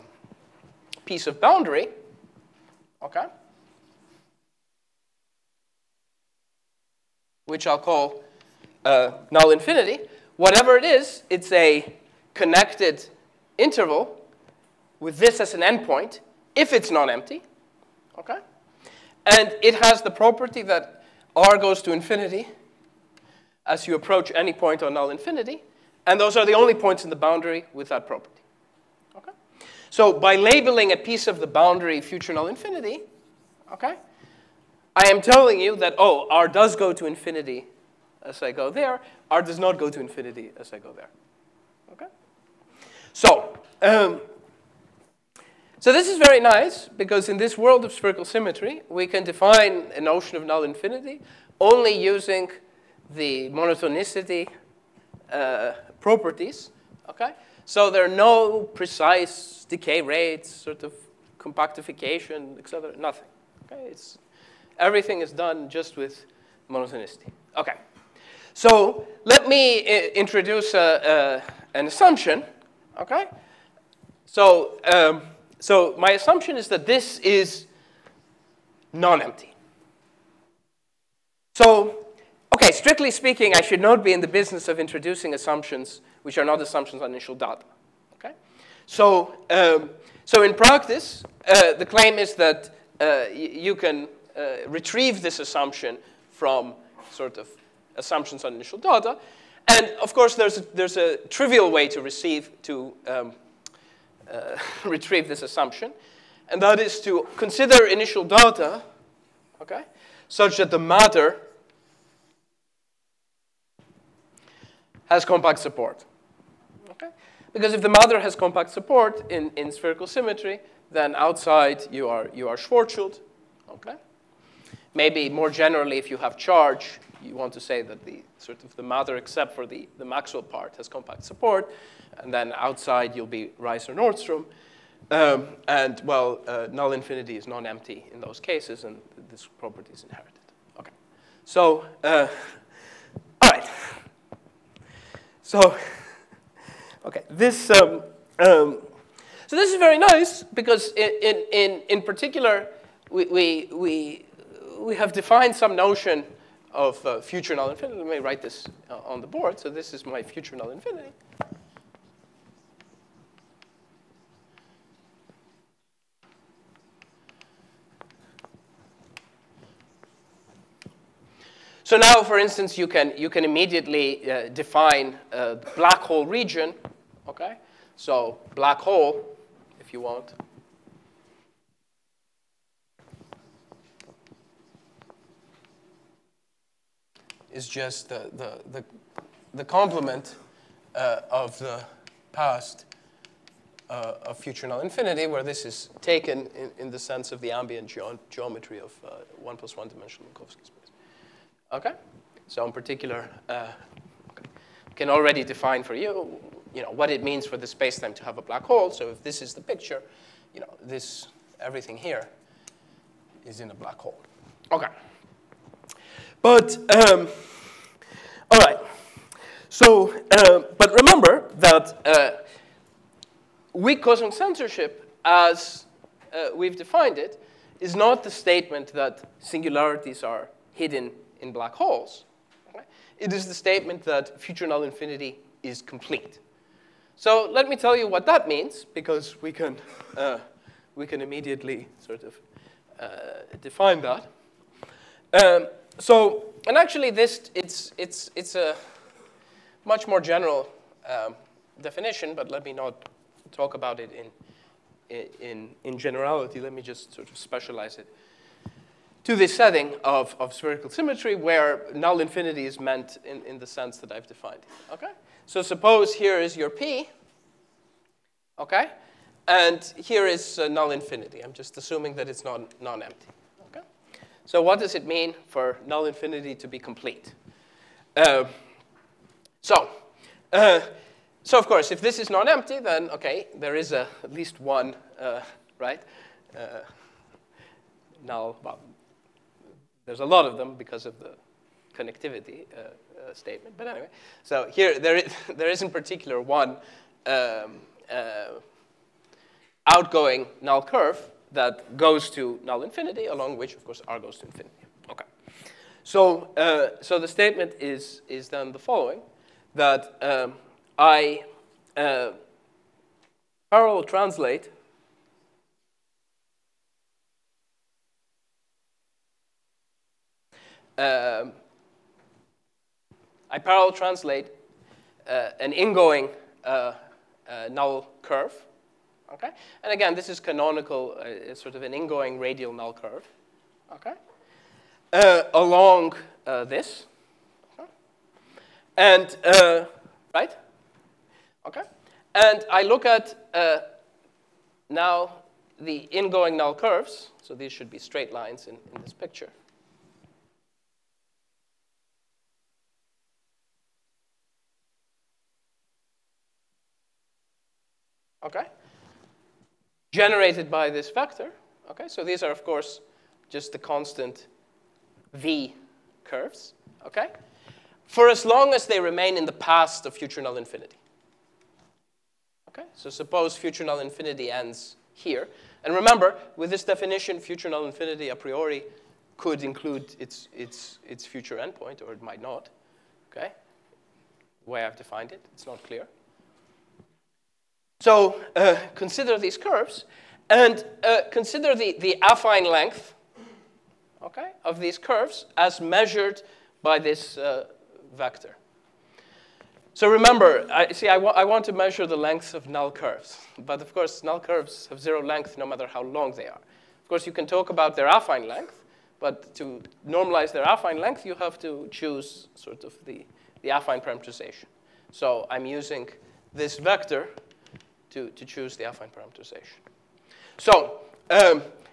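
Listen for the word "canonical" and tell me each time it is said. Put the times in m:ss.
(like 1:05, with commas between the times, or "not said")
5:30.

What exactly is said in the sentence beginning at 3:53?
It is the statement that future null infinity is complete.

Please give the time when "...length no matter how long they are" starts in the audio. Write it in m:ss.
6:45.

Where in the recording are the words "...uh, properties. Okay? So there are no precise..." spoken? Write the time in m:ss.
0:55.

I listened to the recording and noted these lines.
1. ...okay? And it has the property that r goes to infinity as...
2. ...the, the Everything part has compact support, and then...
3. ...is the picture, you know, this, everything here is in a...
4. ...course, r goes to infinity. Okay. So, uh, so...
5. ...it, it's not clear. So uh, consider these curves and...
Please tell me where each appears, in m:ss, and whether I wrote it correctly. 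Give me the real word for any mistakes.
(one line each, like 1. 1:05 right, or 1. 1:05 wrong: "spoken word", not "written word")
1. 0:18 right
2. 2:09 wrong: "Maxwell", not "Everything"
3. 3:29 right
4. 5:03 right
5. 6:25 right.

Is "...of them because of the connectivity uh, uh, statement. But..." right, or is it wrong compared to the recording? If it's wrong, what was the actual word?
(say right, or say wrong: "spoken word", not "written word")
right.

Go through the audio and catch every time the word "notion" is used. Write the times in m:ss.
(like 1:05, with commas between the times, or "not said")
0:50, 2:35.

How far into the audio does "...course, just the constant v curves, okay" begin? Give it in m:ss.
6:02.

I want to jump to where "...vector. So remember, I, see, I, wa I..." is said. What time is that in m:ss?
6:38.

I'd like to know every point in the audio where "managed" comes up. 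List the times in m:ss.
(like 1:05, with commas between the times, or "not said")
not said.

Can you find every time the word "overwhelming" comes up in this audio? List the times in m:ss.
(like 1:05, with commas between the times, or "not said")
not said.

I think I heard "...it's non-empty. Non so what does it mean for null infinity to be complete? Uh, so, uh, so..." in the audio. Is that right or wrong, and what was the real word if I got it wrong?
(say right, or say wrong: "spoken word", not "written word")
right.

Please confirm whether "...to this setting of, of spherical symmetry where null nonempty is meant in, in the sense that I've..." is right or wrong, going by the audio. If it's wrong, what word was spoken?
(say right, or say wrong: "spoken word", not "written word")
wrong: "infinity", not "nonempty".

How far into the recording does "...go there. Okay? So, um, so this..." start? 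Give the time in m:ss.
0:40.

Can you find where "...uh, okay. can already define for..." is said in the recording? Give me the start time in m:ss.
3:23.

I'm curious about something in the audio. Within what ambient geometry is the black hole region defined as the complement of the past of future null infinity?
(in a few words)
1+1 dimensional Minkowski space.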